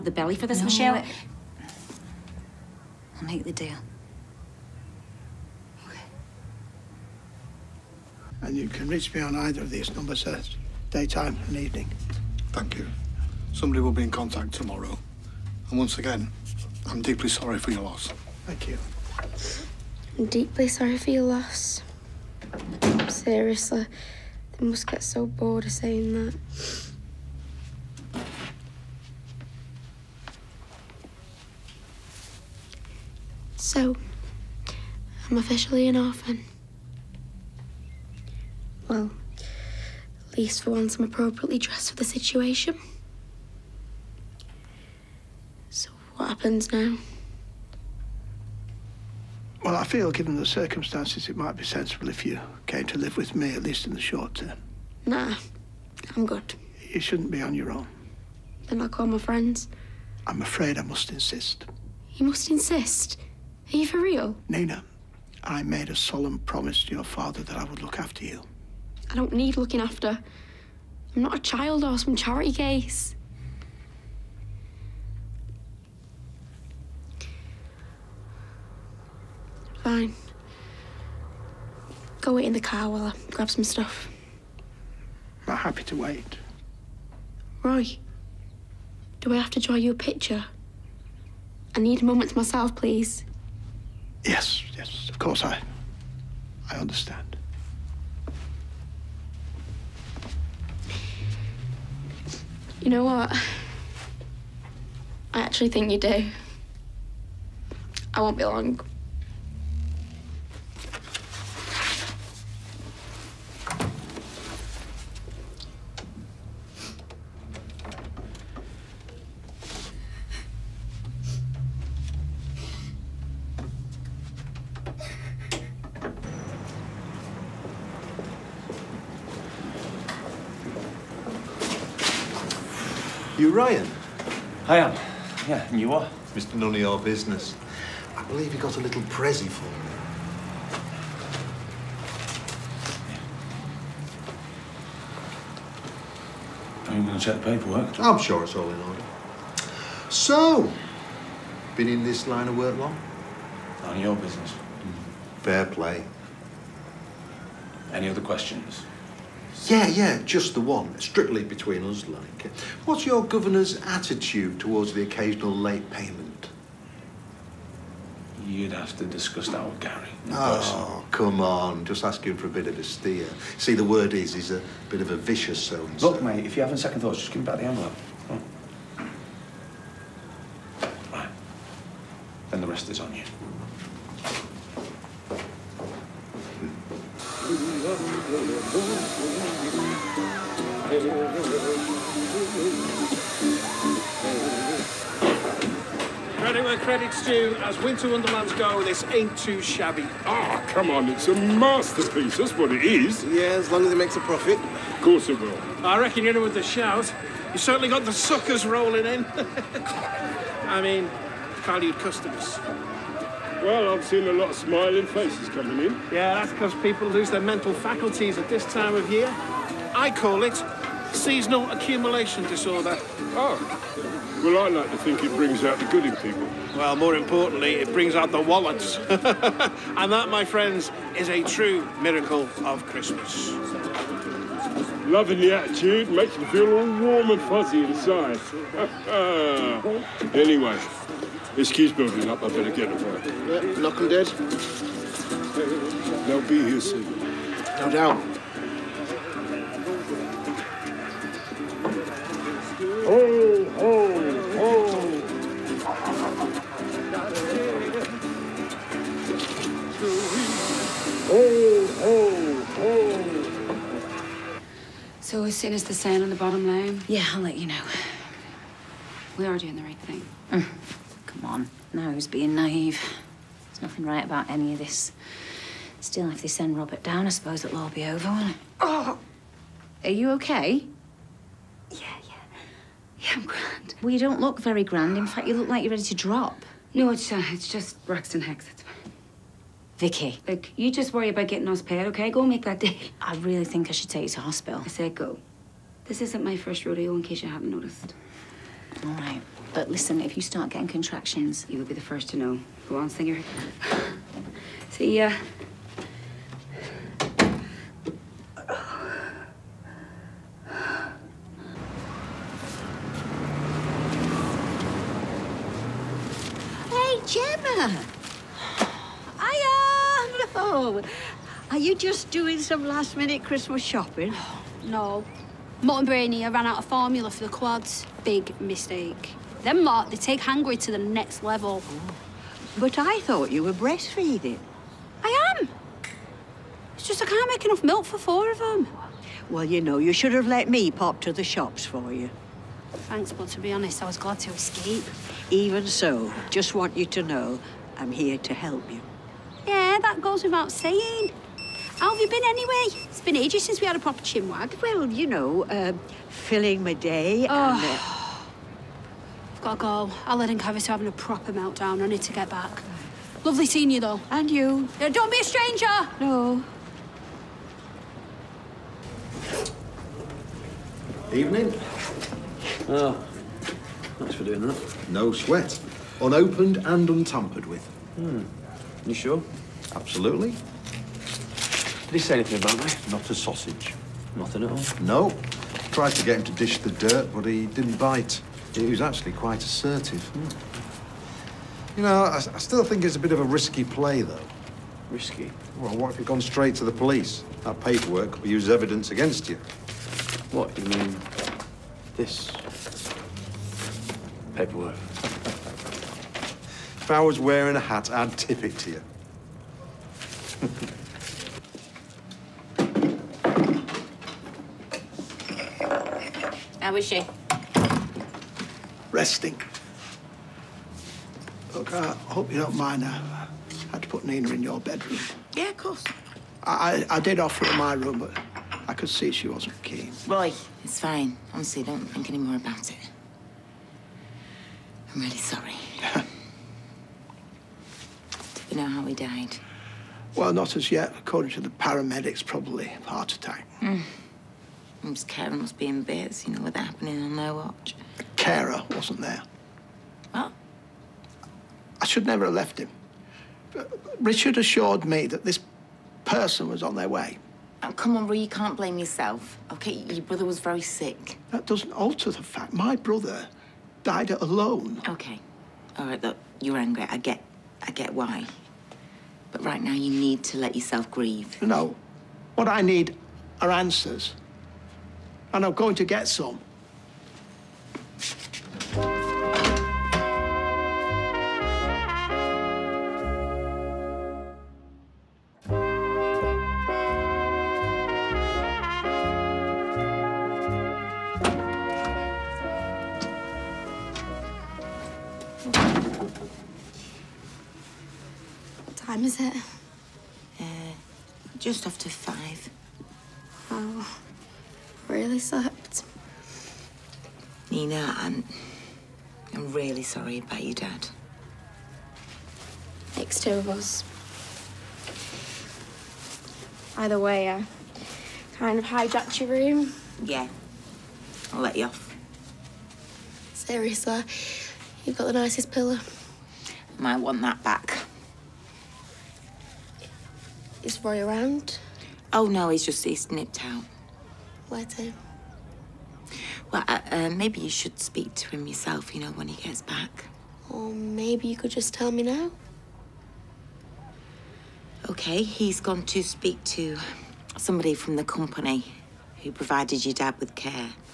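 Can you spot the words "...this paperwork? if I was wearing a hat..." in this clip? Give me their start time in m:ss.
6:42.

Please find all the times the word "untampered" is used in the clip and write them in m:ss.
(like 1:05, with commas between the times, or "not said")
6:17.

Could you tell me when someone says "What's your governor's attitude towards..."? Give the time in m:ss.
2:42.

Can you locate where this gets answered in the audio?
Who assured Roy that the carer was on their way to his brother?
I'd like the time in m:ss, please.
7:34.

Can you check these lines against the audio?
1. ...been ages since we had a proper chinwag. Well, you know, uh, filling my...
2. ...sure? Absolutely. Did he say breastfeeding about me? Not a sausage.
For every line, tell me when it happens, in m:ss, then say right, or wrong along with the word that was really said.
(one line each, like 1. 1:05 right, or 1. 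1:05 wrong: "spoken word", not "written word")
1. 5:53 right
2. 6:19 wrong: "anything", not "breastfeeding".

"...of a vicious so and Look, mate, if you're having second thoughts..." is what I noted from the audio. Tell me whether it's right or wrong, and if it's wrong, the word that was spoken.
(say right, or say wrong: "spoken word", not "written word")
right.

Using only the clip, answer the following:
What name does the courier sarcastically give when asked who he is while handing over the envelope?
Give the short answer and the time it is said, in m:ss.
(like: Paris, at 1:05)
Mr. None of Your Business, at 2:16.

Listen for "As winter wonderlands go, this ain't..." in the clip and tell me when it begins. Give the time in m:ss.
3:17.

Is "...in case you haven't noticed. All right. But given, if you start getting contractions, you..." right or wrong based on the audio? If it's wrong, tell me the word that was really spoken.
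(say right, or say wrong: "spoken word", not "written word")
wrong: "listen", not "given".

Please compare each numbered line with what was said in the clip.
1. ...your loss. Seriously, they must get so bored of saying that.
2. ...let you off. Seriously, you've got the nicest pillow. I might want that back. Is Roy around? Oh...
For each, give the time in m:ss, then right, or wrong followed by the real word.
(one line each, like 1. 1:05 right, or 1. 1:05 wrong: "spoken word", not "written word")
1. 0:21 right
2. 8:41 right.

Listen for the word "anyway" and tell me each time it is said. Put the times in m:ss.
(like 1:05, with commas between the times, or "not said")
4:00, 5:52.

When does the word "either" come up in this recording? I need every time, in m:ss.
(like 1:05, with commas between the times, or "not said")
0:09, 8:36.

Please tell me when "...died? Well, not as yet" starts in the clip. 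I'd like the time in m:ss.
7:19.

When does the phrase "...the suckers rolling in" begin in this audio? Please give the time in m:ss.
3:28.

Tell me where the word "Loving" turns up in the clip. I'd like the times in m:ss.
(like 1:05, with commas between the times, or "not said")
3:55.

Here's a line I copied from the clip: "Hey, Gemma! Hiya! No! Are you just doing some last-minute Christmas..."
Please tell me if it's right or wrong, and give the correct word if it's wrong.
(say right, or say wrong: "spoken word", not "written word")
right.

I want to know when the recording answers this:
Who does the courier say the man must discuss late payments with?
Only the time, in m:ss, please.
2:49.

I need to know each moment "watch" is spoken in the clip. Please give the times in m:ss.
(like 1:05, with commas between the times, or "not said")
7:27.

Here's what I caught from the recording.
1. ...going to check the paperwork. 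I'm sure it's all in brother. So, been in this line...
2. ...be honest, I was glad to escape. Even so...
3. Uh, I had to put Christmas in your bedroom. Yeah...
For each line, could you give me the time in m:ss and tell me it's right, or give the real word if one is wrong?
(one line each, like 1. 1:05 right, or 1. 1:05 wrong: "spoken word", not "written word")
1. 2:27 wrong: "order", not "brother"
2. 5:43 right
3. 7:03 wrong: "Nina", not "Christmas".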